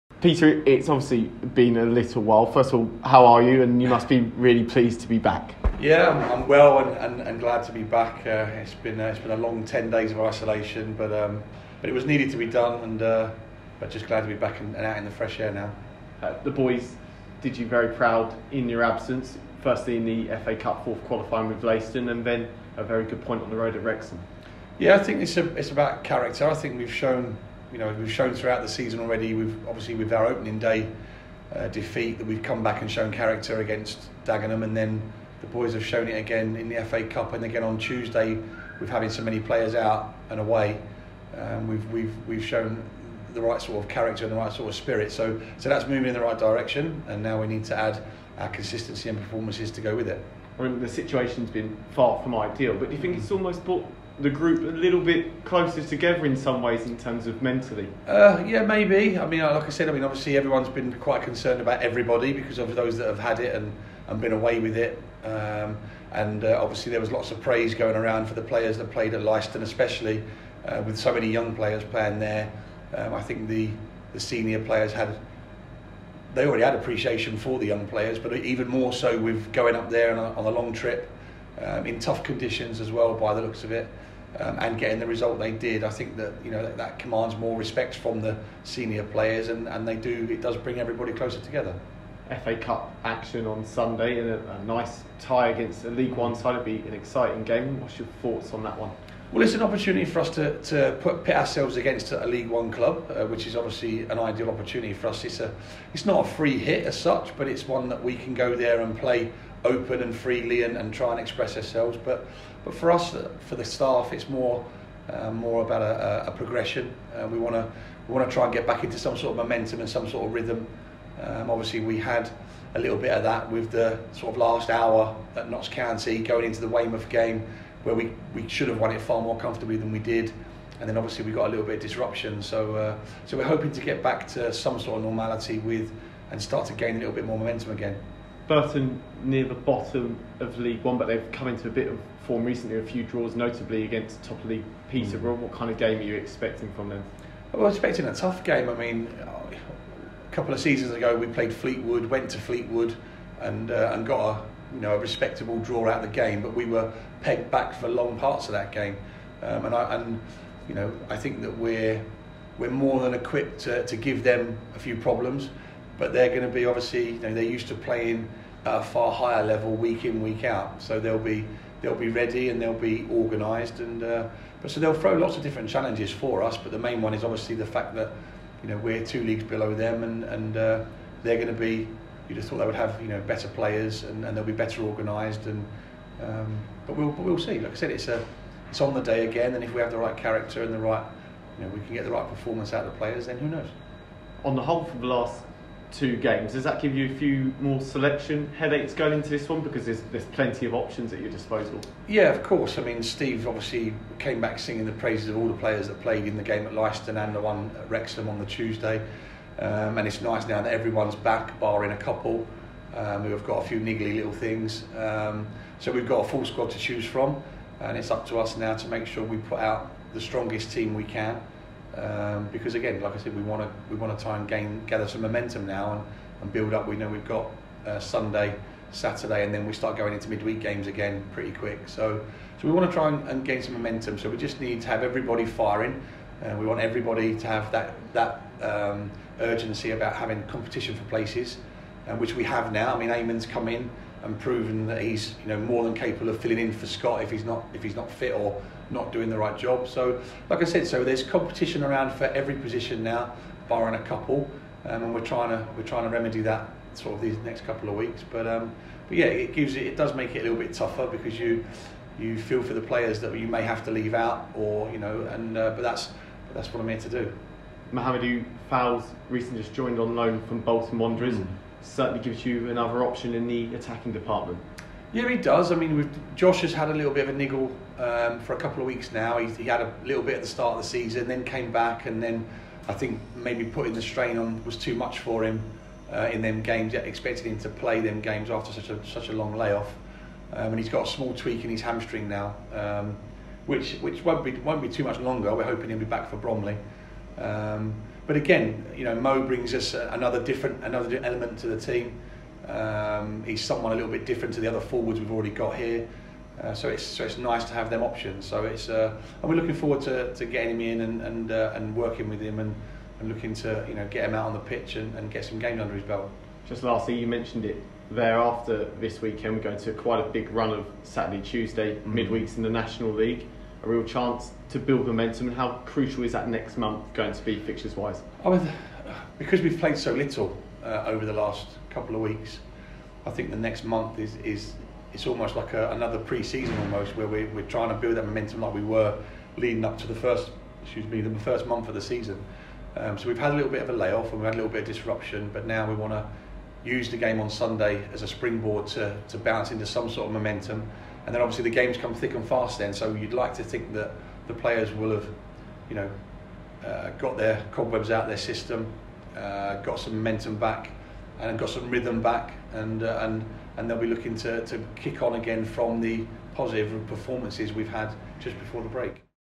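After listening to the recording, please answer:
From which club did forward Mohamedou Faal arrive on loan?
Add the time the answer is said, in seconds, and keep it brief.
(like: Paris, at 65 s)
Bolton Wanderers, at 270 s.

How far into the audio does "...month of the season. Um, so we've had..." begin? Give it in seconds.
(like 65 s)
341 s.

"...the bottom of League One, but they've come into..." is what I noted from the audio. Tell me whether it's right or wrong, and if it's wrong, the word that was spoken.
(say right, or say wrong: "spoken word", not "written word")
right.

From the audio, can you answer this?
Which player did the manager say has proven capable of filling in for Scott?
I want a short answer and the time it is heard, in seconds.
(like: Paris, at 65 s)
Eamon, at 243 s.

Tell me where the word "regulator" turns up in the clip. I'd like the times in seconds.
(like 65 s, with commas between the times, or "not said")
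not said.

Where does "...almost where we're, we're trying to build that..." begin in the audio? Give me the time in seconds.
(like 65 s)
336 s.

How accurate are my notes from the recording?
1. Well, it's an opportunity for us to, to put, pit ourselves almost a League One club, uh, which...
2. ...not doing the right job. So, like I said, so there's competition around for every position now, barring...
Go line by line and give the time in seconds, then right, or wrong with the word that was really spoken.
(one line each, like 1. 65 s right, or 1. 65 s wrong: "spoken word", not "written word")
1. 99 s wrong: "against", not "almost"
2. 248 s right.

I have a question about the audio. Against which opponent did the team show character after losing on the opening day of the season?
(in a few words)
Dagenham.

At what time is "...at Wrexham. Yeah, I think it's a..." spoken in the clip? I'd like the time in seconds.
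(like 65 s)
23 s.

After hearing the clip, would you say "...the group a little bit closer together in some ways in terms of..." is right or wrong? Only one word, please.
right.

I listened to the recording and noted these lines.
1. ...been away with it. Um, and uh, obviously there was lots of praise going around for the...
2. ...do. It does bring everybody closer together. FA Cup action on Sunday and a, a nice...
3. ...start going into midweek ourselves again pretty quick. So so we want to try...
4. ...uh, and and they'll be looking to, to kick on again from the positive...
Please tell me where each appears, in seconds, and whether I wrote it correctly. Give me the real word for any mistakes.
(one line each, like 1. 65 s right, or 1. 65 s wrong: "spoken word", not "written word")
1. 64 s right
2. 89 s right
3. 229 s wrong: "games", not "ourselves"
4. 363 s right.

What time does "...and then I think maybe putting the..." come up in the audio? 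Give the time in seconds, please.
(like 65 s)
282 s.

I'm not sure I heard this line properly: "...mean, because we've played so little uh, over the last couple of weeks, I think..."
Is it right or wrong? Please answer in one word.
right.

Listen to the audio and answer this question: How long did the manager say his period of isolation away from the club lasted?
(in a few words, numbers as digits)
10 days.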